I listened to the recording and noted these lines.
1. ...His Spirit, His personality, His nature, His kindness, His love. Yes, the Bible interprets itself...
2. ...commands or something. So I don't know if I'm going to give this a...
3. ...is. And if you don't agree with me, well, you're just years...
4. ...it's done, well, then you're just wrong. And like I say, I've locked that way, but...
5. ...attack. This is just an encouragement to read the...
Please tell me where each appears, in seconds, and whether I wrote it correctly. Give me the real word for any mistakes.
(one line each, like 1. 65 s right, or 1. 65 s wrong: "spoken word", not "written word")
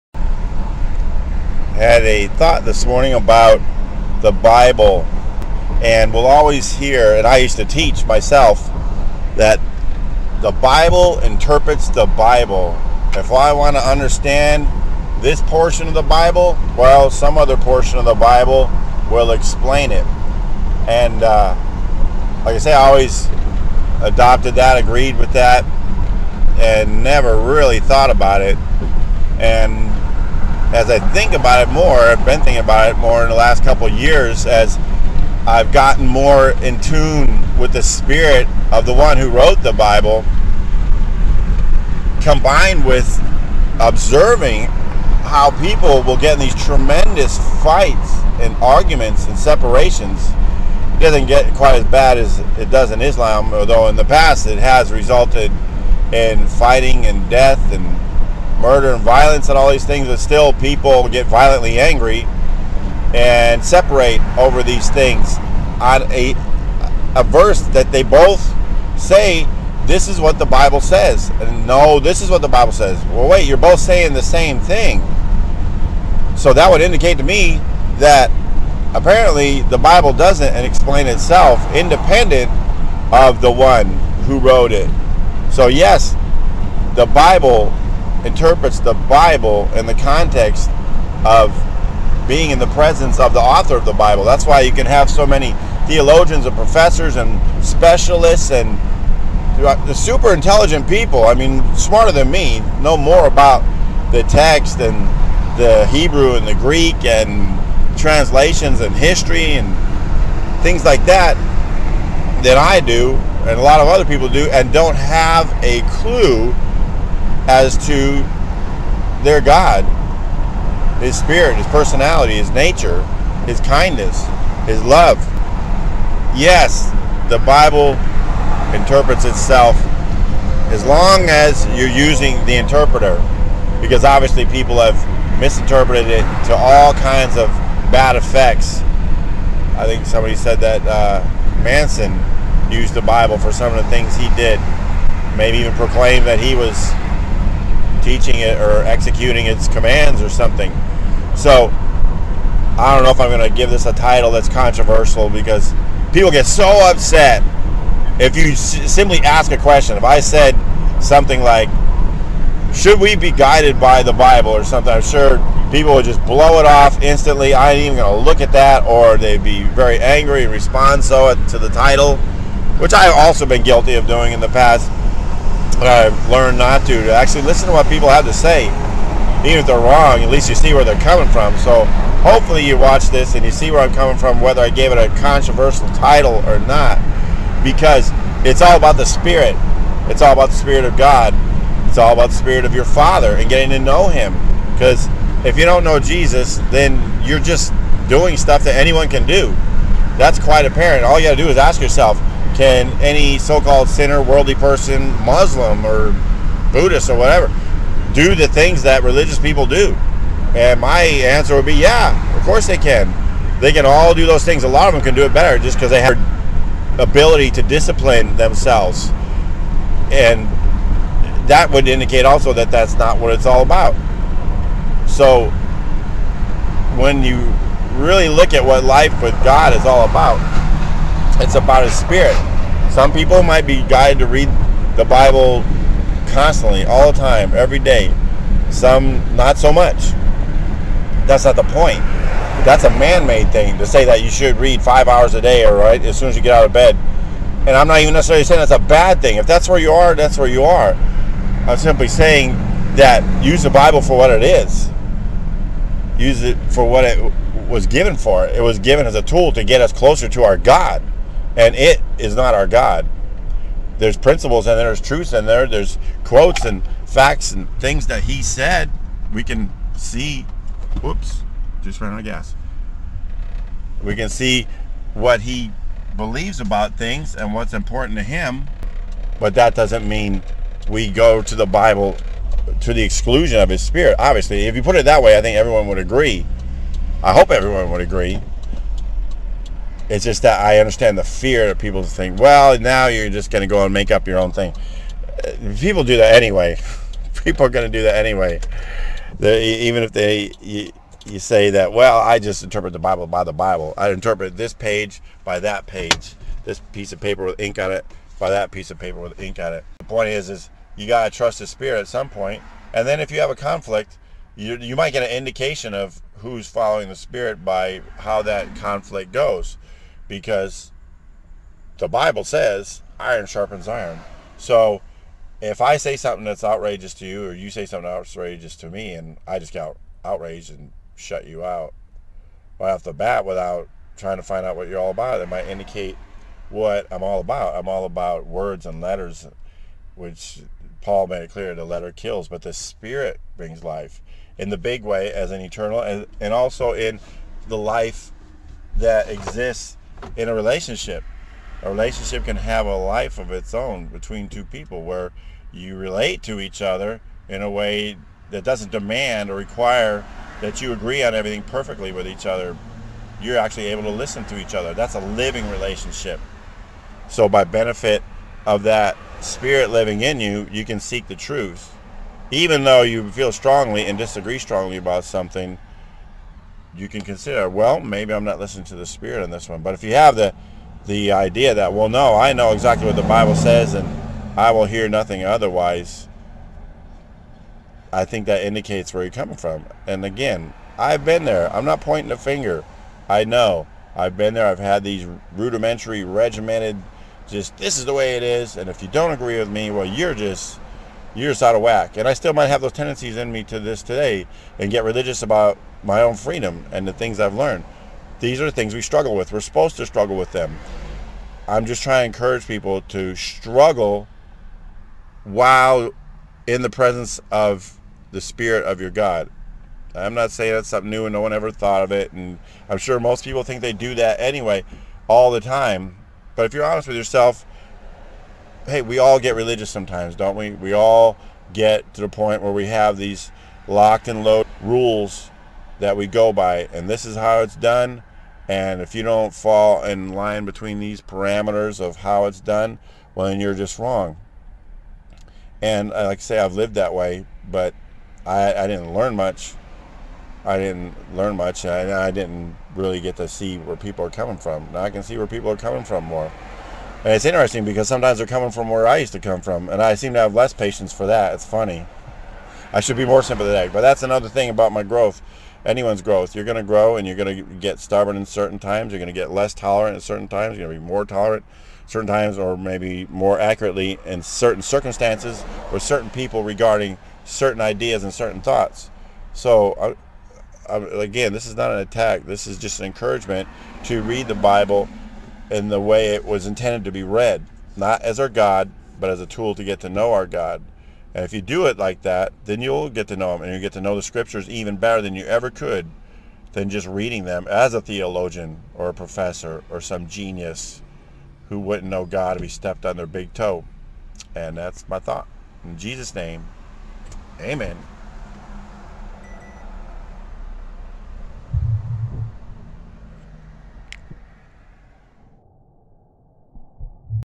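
1. 121 s right
2. 149 s right
3. 398 s right
4. 442 s wrong: "lived", not "locked"
5. 481 s right.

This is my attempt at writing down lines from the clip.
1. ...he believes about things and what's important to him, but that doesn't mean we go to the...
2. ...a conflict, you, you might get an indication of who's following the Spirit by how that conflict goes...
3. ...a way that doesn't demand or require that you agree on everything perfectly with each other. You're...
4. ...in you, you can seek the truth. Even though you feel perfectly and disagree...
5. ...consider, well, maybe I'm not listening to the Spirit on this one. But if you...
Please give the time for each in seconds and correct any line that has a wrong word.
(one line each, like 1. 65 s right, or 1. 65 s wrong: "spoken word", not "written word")
1. 275 s right
2. 313 s right
3. 357 s right
4. 370 s wrong: "strongly", not "perfectly"
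5. 377 s right.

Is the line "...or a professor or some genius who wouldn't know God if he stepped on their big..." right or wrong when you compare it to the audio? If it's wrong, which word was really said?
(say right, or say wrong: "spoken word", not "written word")
right.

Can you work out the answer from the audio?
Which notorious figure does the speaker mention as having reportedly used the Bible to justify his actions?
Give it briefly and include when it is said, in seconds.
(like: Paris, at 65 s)
Manson, at 141 s.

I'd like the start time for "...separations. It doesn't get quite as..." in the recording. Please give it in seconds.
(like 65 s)
49 s.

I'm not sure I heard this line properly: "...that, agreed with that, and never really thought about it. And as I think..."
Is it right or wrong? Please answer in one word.
right.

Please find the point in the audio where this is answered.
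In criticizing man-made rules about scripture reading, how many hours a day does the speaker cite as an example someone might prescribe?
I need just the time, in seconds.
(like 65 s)
244 s.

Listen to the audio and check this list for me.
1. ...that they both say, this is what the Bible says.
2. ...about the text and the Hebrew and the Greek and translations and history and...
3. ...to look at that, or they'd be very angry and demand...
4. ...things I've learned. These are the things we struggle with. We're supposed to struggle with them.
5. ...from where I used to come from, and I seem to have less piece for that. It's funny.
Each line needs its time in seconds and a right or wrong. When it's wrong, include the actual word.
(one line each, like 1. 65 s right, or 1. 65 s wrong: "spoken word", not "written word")
1. 67 s right
2. 103 s right
3. 168 s wrong: "respond", not "demand"
4. 407 s right
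5. 458 s wrong: "patience", not "piece".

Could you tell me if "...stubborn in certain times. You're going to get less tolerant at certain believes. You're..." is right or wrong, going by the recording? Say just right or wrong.
wrong.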